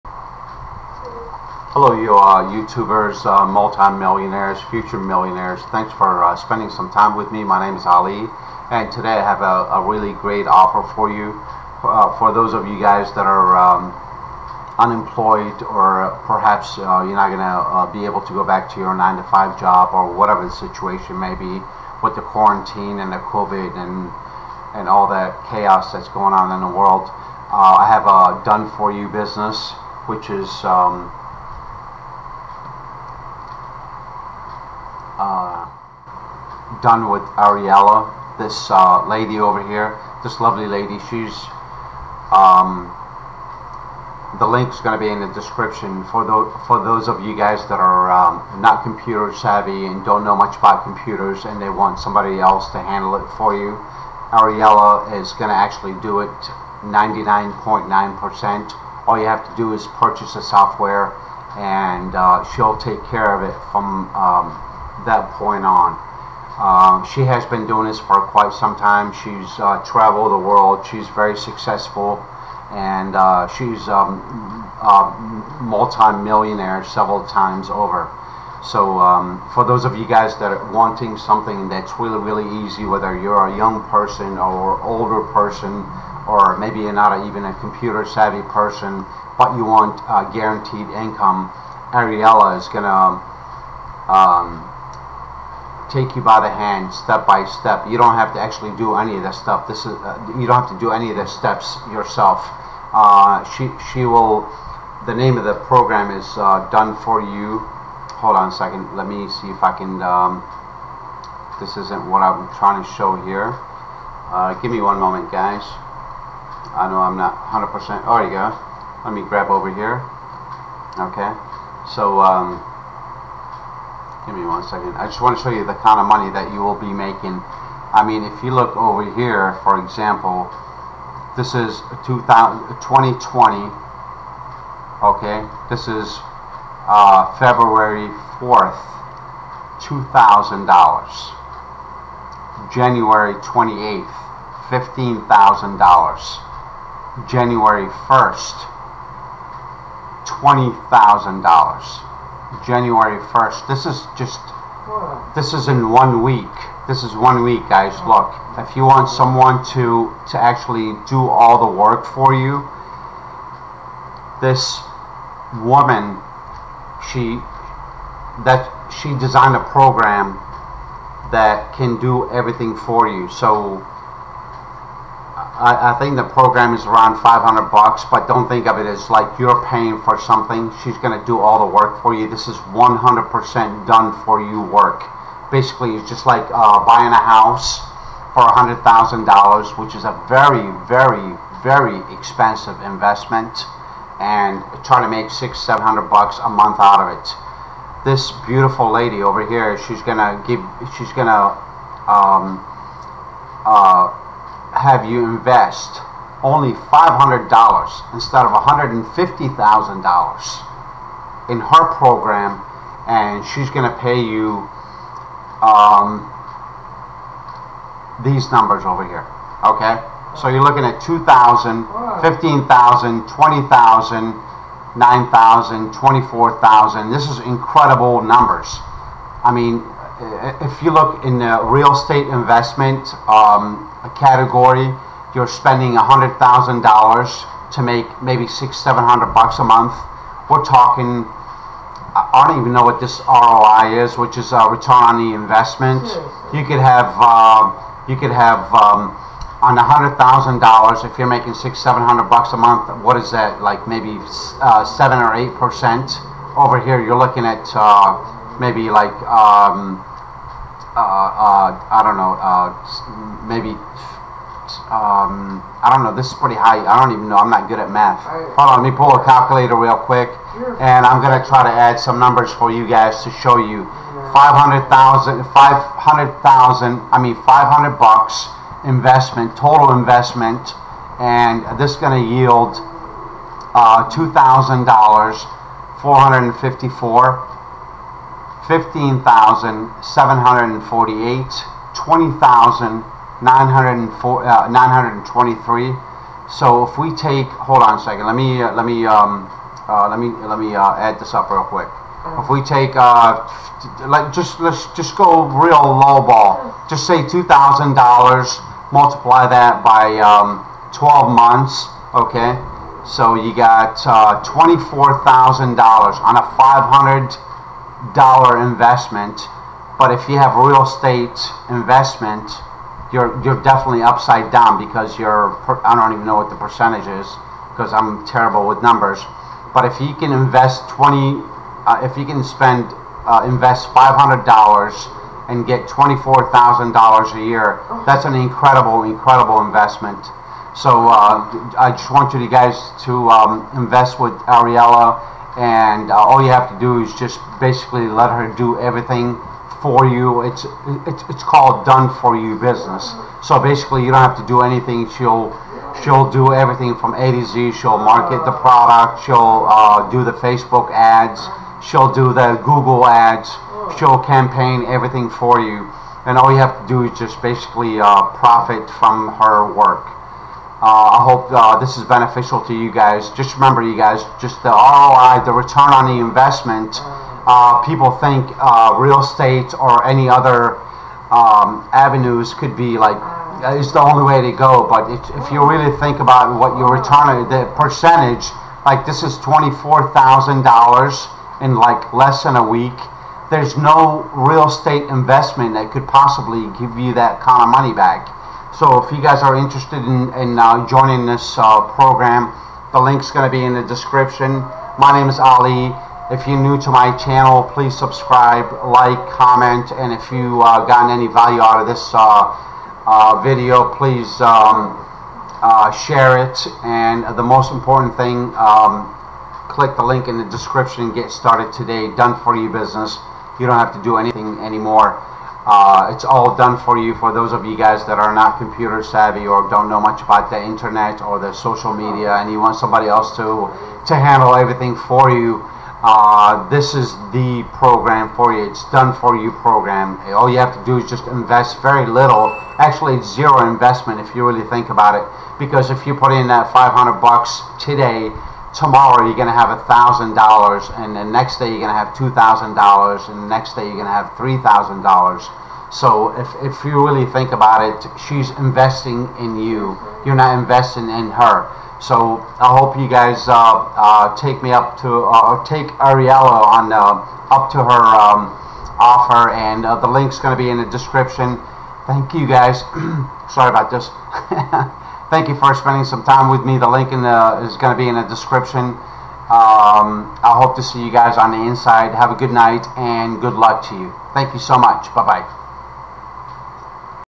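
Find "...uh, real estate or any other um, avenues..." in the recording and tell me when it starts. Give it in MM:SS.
06:18.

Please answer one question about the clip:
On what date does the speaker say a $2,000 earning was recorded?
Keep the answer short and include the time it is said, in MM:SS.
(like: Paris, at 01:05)
February 4th, at 02:17.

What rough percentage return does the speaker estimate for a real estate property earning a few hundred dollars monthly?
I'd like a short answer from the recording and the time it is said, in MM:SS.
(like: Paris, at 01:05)
7 or 8%, at 04:14.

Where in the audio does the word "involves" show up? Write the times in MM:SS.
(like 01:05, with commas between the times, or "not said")
not said.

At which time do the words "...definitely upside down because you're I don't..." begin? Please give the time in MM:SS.
05:23.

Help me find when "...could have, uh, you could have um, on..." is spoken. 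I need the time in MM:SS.
04:06.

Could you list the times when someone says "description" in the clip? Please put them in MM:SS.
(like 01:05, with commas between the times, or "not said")
00:45, 06:43, 07:00, 07:50, 07:58.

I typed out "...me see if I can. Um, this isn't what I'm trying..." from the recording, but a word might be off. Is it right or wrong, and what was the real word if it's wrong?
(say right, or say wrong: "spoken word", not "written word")
right.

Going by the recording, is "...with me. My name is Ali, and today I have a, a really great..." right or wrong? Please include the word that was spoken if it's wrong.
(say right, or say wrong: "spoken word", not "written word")
right.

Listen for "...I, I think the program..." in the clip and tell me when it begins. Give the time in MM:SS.
02:55.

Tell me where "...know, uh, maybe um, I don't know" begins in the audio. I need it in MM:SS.
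04:22.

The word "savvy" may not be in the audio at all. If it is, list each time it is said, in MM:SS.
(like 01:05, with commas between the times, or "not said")
00:49, 01:28, 07:09.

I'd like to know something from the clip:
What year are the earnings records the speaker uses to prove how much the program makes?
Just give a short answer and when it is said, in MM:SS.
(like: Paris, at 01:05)
2020, at 02:12.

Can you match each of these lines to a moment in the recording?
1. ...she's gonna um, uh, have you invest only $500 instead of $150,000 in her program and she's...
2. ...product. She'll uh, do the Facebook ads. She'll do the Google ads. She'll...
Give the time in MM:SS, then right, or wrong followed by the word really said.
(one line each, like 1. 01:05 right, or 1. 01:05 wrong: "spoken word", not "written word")
1. 03:20 right
2. 05:58 right.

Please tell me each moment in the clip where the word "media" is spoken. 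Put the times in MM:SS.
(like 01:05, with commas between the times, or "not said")
07:11.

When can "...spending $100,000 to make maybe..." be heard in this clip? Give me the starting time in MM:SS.
03:55.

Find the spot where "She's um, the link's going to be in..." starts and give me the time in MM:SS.
00:41.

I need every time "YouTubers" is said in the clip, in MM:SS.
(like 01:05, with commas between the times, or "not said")
00:02.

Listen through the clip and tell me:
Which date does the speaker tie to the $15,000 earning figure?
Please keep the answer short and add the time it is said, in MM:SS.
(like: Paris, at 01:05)
January 28th, at 02:22.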